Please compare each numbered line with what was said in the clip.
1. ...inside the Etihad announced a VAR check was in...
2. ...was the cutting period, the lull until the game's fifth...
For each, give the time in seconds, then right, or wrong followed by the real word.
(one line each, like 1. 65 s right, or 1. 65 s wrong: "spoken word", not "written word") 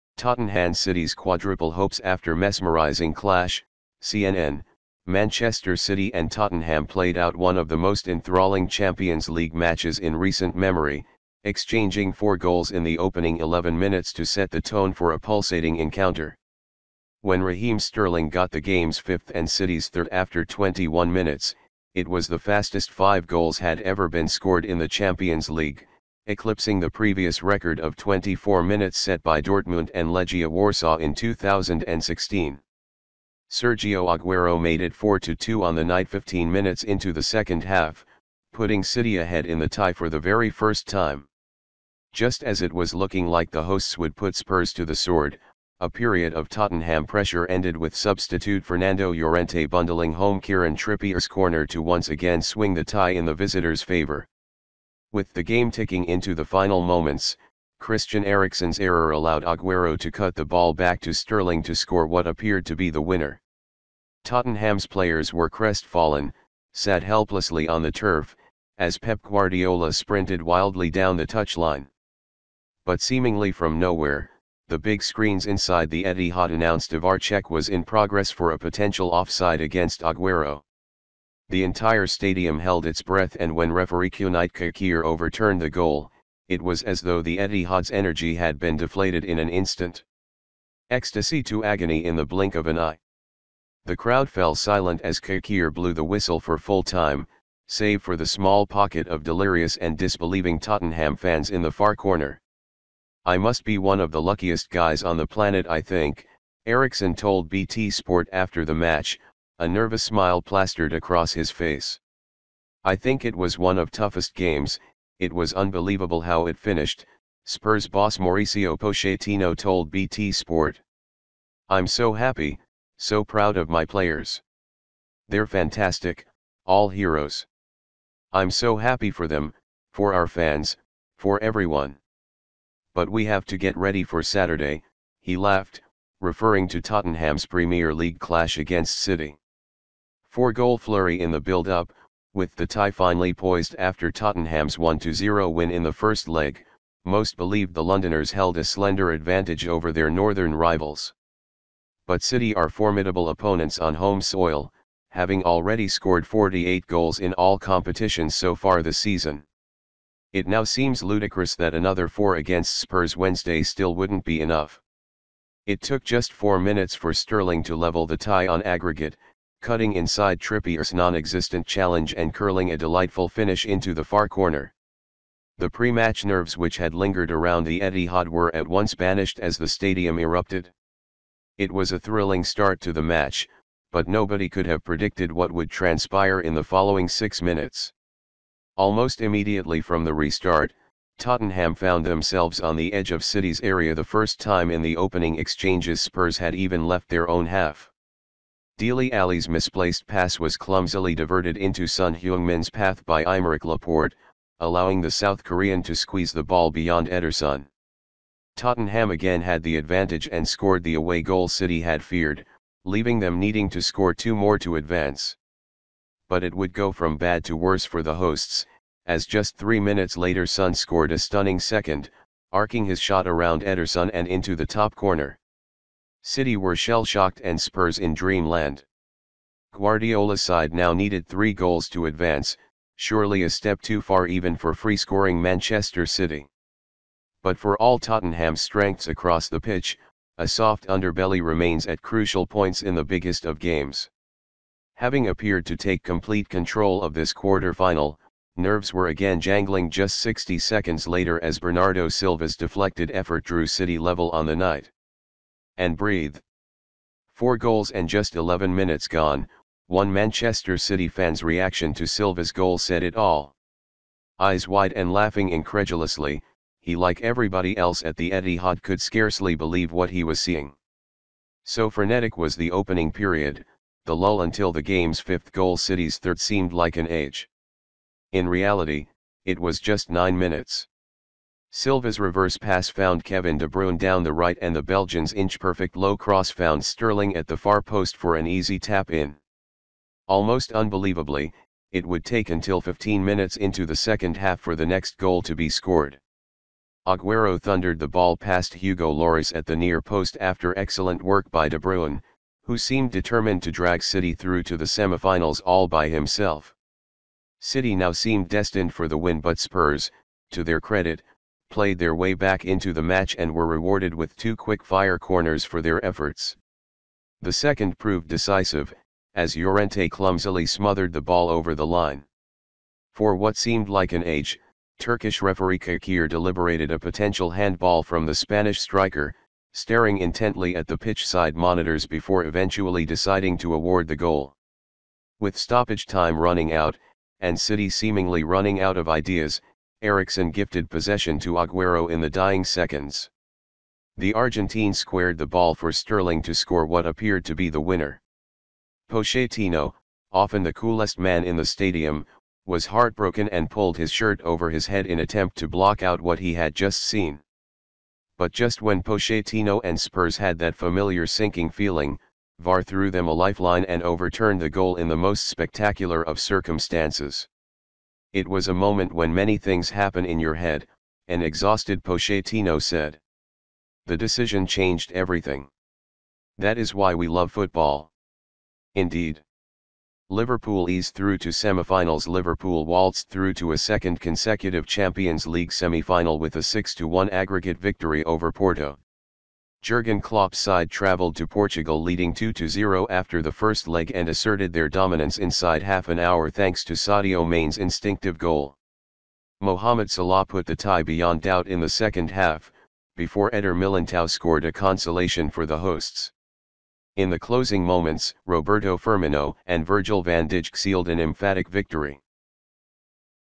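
1. 75 s right
2. 272 s wrong: "opening", not "cutting".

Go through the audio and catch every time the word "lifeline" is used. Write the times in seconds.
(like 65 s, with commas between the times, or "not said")
363 s.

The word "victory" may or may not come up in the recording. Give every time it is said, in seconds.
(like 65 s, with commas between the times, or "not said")
387 s, 411 s.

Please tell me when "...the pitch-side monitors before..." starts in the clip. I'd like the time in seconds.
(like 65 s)
330 s.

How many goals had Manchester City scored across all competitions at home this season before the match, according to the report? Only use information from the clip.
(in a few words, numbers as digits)
48.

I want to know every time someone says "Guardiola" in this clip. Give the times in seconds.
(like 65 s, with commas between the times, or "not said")
69 s, 229 s.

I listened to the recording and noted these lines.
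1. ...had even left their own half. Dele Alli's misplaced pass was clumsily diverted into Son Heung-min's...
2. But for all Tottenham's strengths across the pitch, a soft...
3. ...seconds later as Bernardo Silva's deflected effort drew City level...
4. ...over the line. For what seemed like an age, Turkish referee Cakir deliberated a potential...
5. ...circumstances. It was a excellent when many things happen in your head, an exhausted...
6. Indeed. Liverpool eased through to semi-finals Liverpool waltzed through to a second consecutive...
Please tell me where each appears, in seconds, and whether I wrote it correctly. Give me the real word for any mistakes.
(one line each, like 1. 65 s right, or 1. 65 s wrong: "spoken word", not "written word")
1. 196 s right
2. 237 s right
3. 250 s right
4. 321 s right
5. 366 s wrong: "moment", not "excellent"
6. 378 s right.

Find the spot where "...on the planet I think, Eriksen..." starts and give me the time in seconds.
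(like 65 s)
105 s.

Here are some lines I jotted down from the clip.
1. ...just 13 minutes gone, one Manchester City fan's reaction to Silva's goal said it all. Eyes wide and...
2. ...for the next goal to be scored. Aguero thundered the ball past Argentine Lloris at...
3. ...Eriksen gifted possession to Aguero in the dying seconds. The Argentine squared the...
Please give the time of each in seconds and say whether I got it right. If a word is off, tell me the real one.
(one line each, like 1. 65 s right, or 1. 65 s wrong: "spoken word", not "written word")
1. 258 s wrong: "11", not "13"
2. 294 s wrong: "Hugo", not "Argentine"
3. 340 s right.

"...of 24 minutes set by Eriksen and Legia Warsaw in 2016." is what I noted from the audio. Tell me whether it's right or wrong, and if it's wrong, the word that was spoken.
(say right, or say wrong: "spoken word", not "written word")
wrong: "Dortmund", not "Eriksen".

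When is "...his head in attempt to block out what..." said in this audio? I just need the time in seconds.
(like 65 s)
354 s.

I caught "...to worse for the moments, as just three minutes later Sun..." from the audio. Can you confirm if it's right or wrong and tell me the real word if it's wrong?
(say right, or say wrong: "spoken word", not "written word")
wrong: "hosts", not "moments".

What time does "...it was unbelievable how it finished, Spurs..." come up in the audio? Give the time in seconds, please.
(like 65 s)
115 s.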